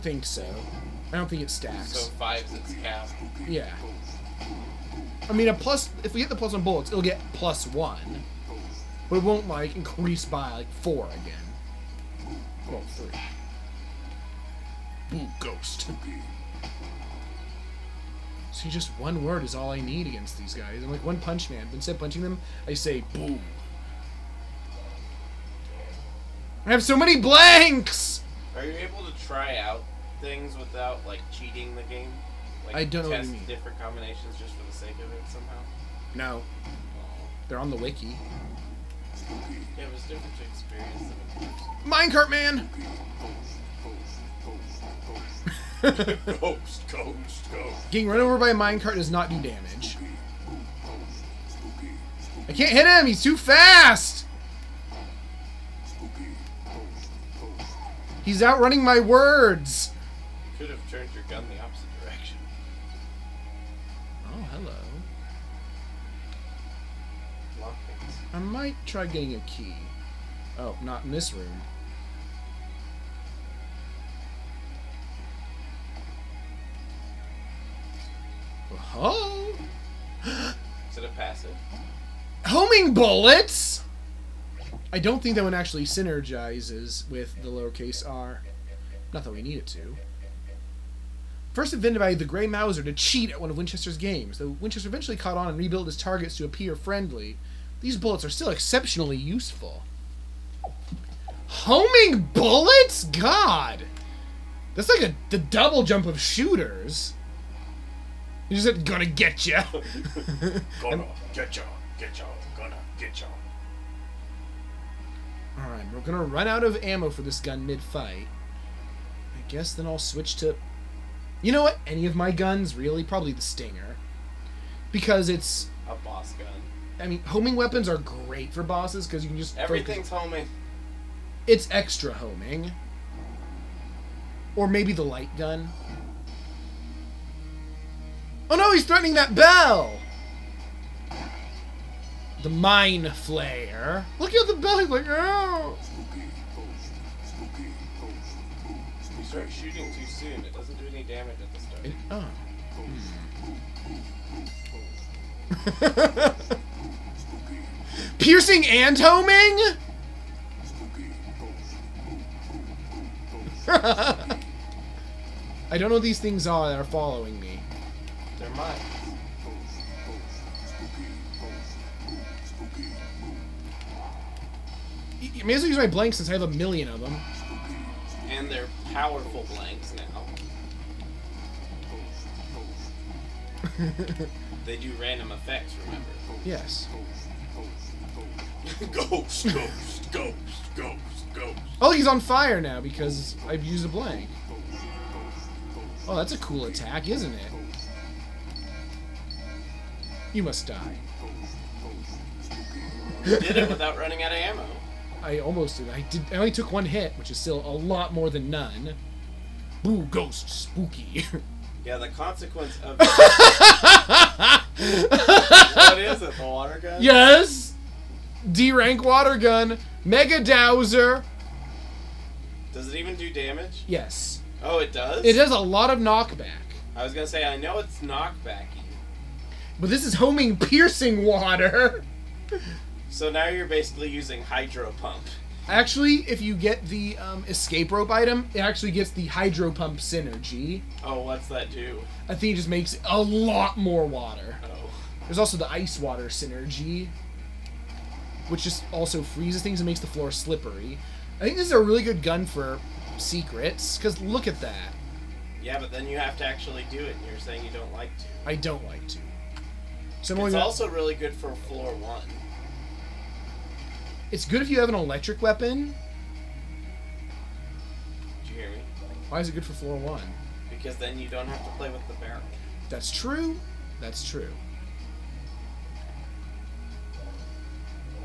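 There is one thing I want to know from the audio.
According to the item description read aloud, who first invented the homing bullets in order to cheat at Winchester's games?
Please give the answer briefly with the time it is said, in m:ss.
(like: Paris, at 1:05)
The Grey Mauser, at 1:32.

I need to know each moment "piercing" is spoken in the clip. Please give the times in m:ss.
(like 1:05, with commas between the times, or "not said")
2:38, 3:50.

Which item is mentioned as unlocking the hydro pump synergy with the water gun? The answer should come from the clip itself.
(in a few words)
escape rope.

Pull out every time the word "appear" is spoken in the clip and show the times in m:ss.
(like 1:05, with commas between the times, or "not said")
1:36.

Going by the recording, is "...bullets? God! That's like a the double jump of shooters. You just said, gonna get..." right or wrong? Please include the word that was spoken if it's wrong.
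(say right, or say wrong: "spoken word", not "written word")
right.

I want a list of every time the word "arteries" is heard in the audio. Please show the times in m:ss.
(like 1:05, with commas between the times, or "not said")
not said.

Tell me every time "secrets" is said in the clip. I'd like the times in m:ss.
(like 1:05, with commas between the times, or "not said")
4:13.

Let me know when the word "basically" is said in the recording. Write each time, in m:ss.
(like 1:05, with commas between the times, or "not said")
3:53.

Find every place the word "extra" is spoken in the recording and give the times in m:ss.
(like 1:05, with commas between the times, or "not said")
2:11.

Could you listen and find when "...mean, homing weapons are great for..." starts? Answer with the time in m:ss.
2:07.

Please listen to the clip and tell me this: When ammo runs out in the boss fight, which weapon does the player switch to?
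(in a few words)
The Stinger.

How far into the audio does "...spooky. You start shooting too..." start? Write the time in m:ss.
2:29.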